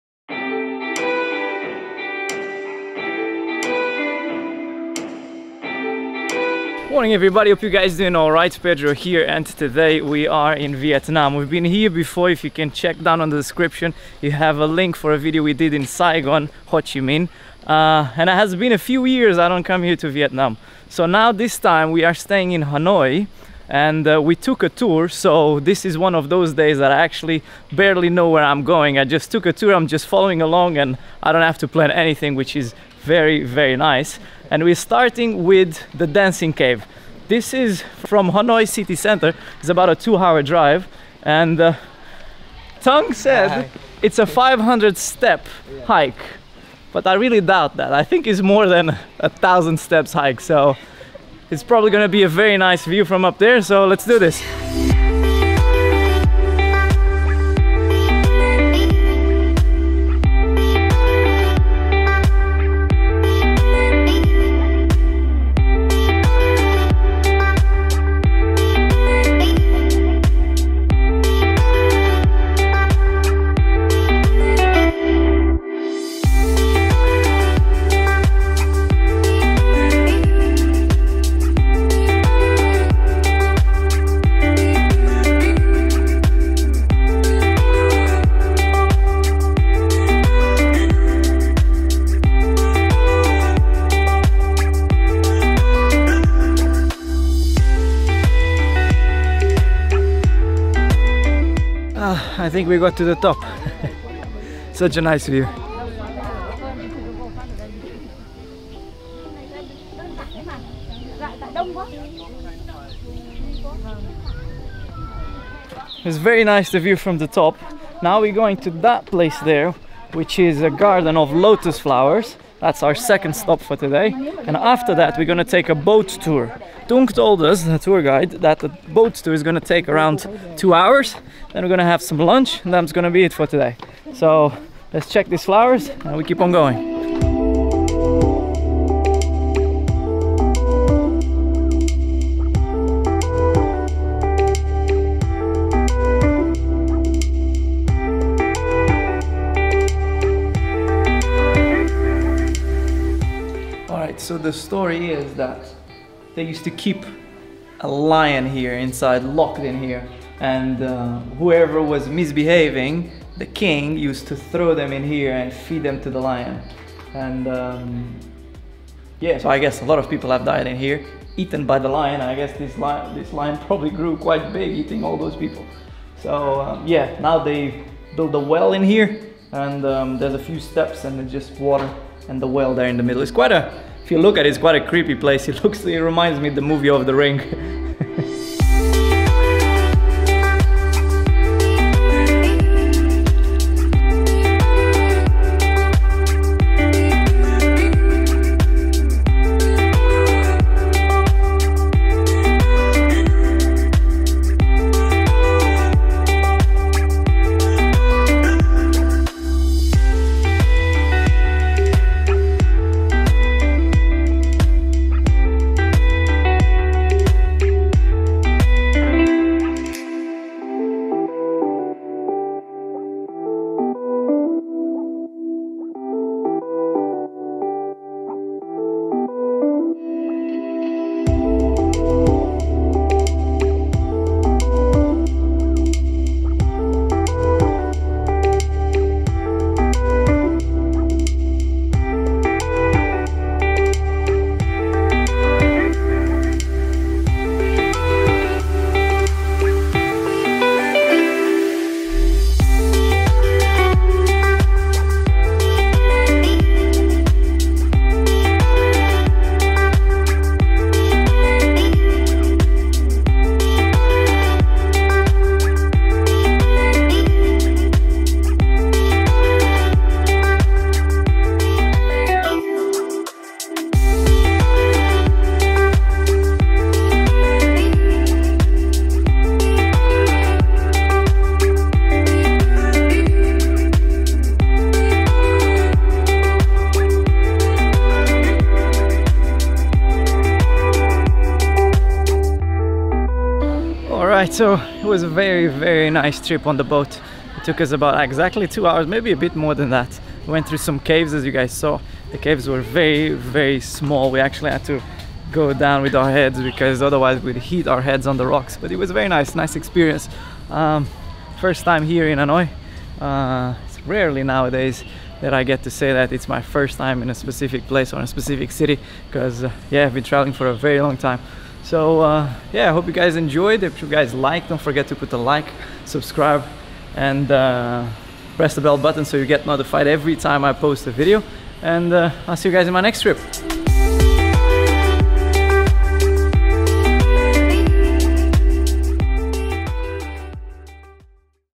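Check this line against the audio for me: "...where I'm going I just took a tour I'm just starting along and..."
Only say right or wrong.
wrong.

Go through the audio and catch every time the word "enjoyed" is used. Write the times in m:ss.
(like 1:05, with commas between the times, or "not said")
5:23.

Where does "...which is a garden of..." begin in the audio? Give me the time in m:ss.
2:00.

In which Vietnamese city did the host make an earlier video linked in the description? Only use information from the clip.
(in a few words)
Saigon.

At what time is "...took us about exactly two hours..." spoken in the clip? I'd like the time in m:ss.
4:57.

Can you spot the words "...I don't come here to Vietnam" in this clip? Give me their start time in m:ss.
0:19.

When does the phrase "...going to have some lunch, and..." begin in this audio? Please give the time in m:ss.
2:11.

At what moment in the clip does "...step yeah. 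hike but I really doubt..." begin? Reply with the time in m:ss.
0:44.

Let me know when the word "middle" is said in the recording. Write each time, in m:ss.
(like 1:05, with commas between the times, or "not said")
3:03.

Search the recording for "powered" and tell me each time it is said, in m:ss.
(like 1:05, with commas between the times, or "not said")
not said.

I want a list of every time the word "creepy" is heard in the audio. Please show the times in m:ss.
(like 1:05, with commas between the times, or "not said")
3:04.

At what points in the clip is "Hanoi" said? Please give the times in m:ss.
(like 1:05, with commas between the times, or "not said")
0:22, 0:38, 5:12.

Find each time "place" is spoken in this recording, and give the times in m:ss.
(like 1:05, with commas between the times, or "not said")
1:59, 3:05, 5:17.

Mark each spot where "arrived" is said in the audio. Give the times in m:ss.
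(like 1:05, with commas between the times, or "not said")
not said.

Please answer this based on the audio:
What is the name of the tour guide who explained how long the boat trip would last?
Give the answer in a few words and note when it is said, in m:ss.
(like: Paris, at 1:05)
Tung, at 2:06.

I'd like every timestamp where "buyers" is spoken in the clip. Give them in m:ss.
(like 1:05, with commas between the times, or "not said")
not said.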